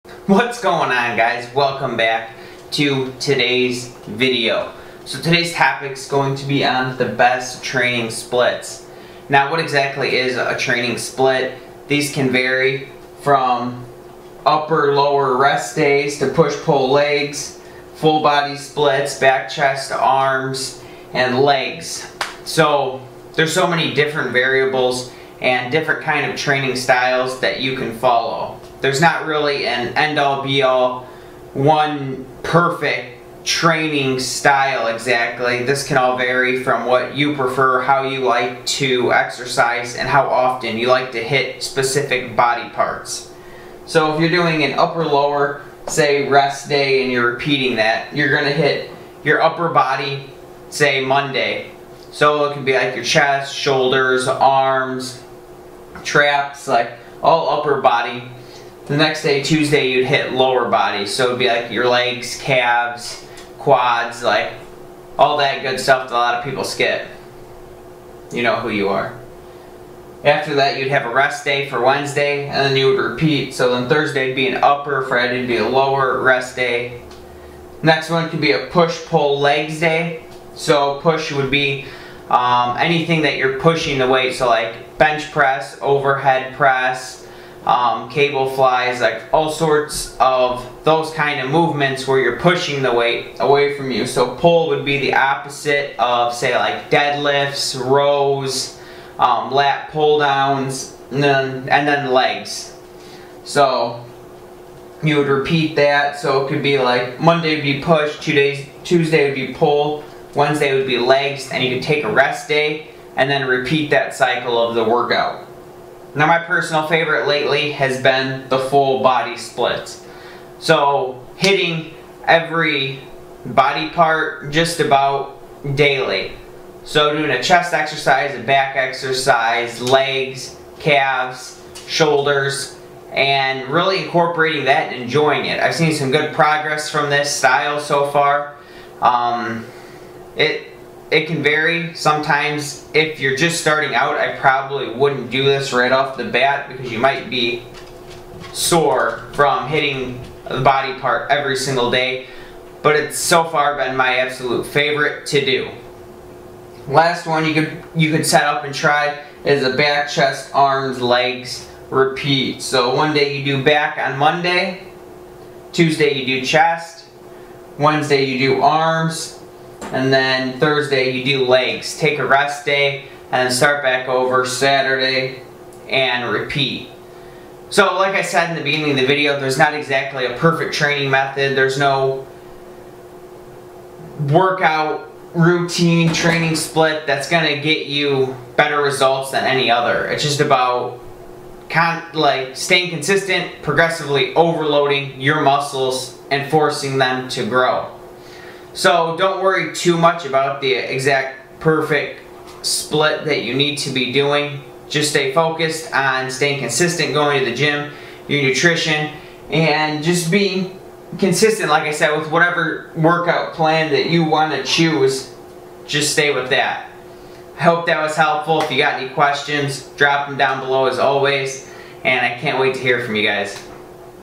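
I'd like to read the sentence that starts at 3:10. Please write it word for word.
It's just about like staying consistent, progressively overloading your muscles and forcing them to grow.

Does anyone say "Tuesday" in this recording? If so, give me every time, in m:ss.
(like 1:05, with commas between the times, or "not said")
0:59, 1:48, 2:45.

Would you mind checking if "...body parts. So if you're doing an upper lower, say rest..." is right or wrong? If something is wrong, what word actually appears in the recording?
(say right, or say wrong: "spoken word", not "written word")
right.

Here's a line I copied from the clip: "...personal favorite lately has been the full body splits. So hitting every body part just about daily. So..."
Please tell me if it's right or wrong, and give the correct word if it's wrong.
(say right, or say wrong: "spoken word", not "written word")
right.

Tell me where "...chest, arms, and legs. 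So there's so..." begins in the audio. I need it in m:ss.
0:19.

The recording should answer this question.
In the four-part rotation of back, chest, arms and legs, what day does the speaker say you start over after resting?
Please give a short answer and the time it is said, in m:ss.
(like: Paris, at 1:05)
Saturday, at 2:54.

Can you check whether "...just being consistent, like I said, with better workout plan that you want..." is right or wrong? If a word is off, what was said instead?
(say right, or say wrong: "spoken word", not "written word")
wrong: "whatever", not "better".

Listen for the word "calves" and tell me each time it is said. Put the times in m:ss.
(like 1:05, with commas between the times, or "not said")
1:02, 2:10.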